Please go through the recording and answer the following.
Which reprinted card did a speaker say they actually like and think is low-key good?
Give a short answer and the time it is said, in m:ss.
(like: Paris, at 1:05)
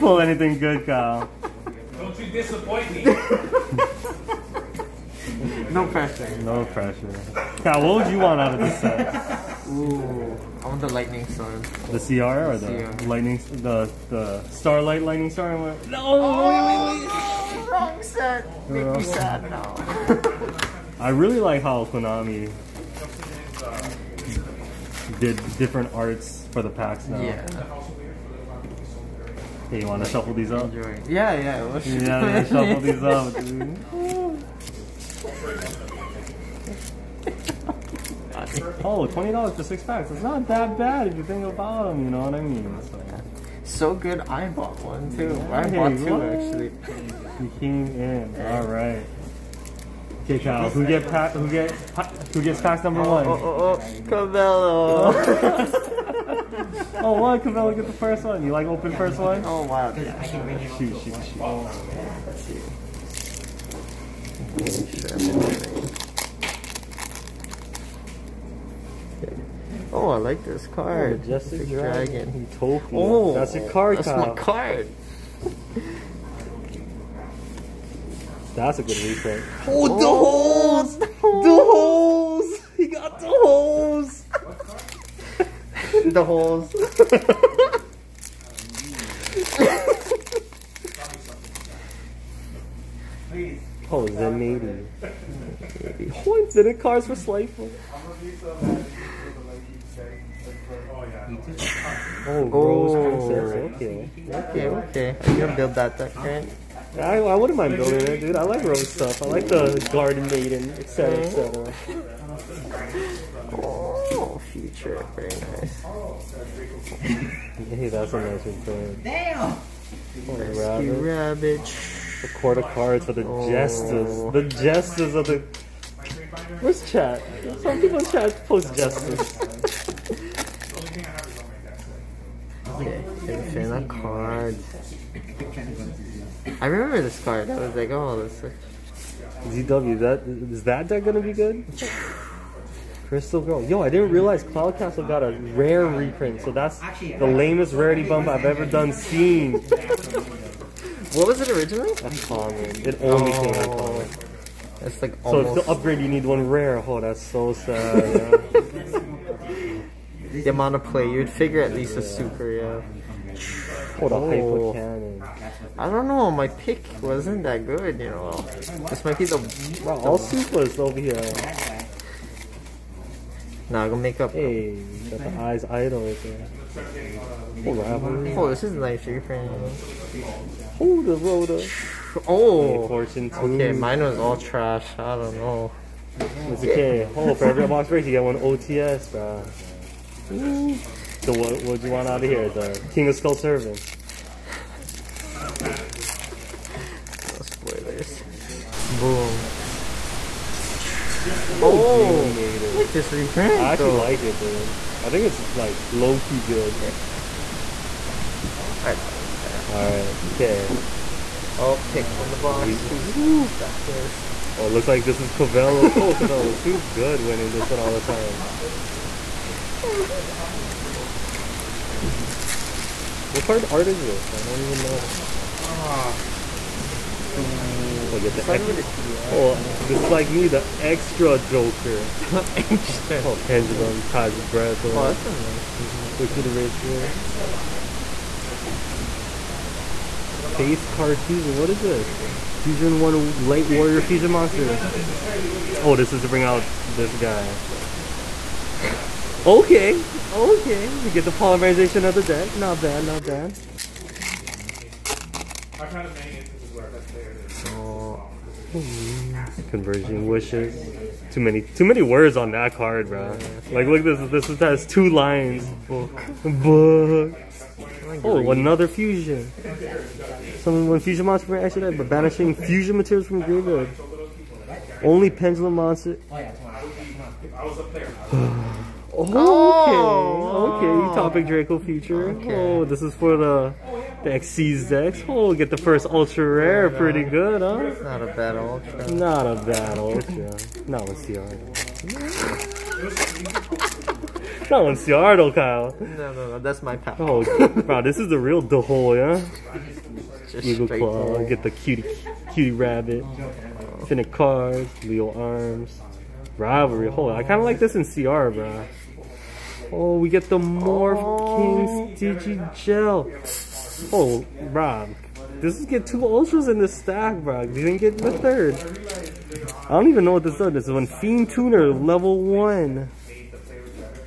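Geonator, at 3:21.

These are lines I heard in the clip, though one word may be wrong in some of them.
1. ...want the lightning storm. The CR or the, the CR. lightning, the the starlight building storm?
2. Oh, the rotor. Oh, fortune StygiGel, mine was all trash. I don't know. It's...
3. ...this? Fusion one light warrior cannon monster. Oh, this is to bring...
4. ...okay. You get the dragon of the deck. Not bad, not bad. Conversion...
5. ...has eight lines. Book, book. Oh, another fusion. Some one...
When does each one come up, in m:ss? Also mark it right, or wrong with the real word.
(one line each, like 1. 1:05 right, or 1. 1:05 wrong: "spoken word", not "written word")
1. 0:10 wrong: "lightning", not "building"
2. 3:00 wrong: "Okay", not "StygiGel"
3. 4:01 wrong: "fusion", not "cannon"
4. 4:10 wrong: "polymerization", not "dragon"
5. 4:24 wrong: "two", not "eight".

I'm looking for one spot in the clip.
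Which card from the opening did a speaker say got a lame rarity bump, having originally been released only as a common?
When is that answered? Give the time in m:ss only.
2:24.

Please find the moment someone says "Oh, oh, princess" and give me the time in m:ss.
1:42.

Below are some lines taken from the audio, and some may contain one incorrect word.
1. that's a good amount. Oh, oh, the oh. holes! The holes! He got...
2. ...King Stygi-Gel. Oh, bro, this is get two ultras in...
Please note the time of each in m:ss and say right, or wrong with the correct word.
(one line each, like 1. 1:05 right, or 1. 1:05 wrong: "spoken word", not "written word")
1. 1:18 wrong: "reprint", not "amount"
2. 5:12 right.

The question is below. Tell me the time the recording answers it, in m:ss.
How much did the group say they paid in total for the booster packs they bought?
0:39.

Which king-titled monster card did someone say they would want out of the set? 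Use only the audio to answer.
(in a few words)
The King of Skull Servants.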